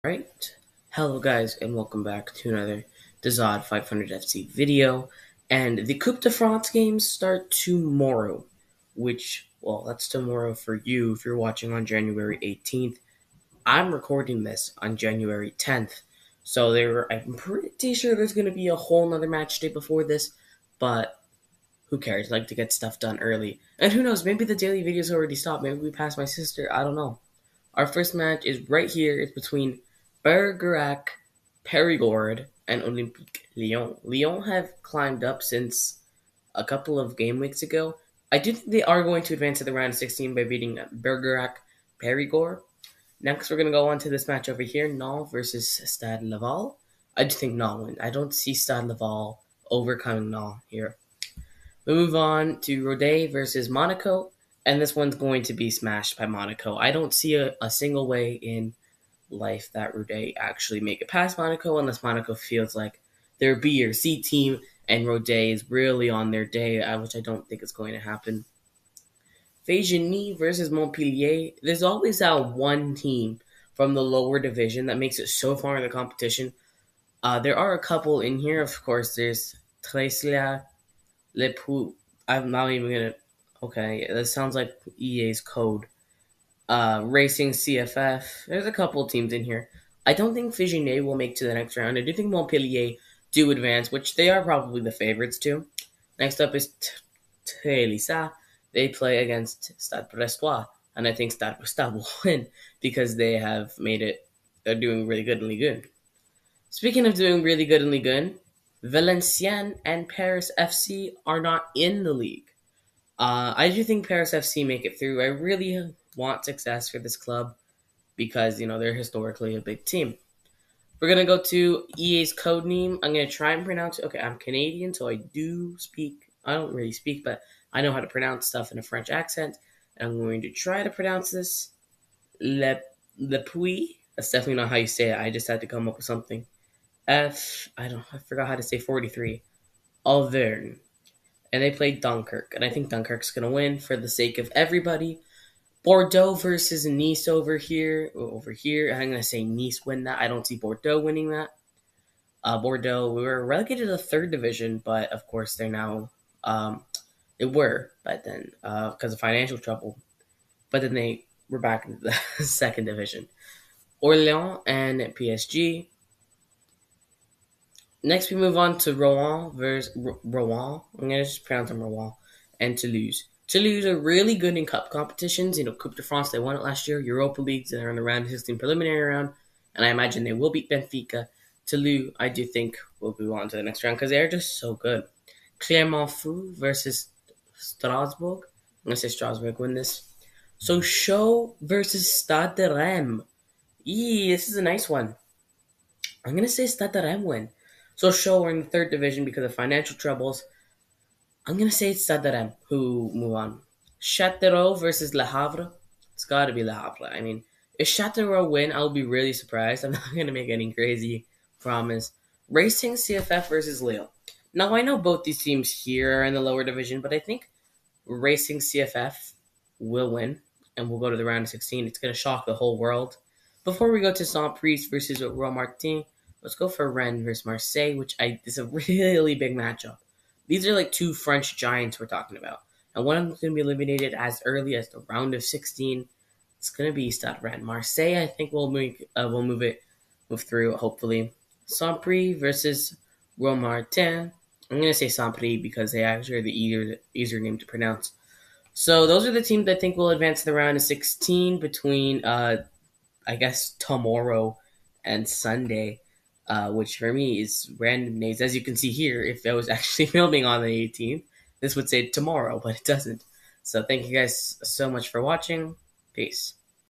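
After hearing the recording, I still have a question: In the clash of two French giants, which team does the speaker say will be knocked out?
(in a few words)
Stade Rennes.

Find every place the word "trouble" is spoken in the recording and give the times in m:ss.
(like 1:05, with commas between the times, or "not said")
2:39, 3:19.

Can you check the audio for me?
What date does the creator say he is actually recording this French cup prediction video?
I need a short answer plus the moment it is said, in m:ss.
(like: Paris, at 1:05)
January 10th, at 0:14.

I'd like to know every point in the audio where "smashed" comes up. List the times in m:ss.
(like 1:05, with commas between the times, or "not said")
0:55.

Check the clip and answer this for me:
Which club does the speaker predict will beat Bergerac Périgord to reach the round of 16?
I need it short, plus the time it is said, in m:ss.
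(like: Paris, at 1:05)
Olympique Lyon, at 0:32.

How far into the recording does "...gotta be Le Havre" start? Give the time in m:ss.
3:26.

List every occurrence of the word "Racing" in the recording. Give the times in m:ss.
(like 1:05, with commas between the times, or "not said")
1:27, 3:32, 3:38.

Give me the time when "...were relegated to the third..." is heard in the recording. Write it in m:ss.
2:33.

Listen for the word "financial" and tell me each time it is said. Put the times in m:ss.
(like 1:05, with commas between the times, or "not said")
2:39, 3:19.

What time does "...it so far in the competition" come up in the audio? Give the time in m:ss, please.
1:15.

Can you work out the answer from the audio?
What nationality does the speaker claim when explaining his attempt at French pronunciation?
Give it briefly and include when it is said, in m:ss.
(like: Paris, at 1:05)
Canadian, at 2:04.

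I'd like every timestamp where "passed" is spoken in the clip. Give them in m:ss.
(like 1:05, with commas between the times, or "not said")
0:25.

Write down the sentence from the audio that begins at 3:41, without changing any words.
It's gonna shock the whole world.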